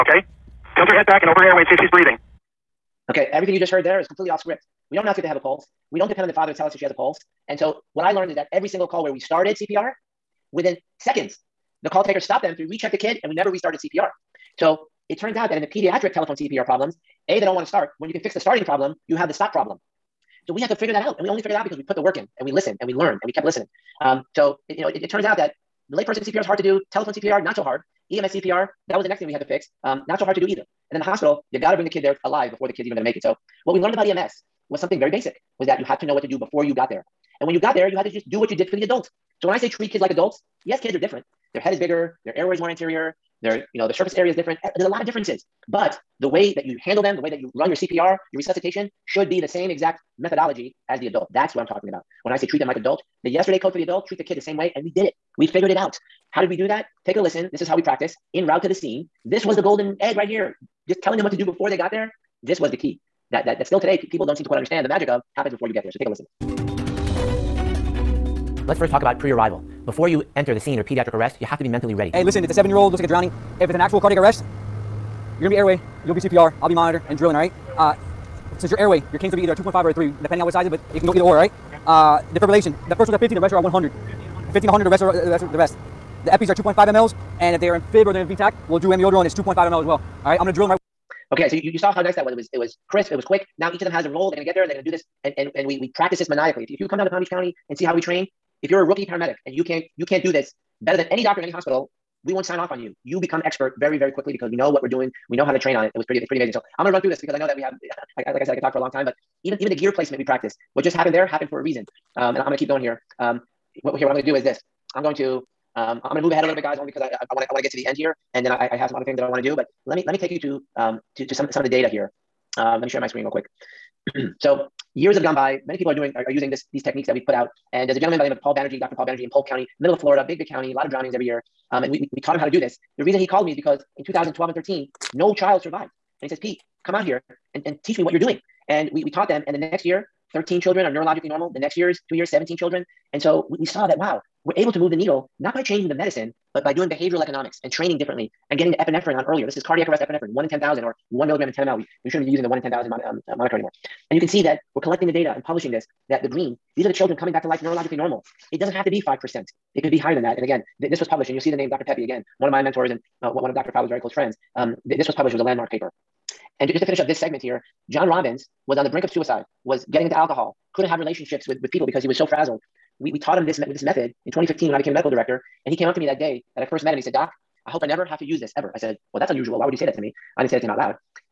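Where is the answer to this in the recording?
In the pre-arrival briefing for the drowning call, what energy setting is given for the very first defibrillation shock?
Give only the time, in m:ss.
1:22.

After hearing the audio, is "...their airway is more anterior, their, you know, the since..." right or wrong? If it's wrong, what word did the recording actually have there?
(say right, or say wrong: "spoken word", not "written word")
wrong: "surface", not "since".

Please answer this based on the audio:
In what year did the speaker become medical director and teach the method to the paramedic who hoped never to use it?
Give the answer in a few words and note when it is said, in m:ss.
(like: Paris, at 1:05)
2015, at 2:54.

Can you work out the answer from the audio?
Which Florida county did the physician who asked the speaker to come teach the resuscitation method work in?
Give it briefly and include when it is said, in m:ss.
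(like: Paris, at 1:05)
Polk County, at 2:09.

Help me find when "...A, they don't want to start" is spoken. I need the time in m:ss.
0:17.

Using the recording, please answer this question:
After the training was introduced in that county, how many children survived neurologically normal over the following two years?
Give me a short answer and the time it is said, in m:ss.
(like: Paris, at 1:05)
17, at 2:22.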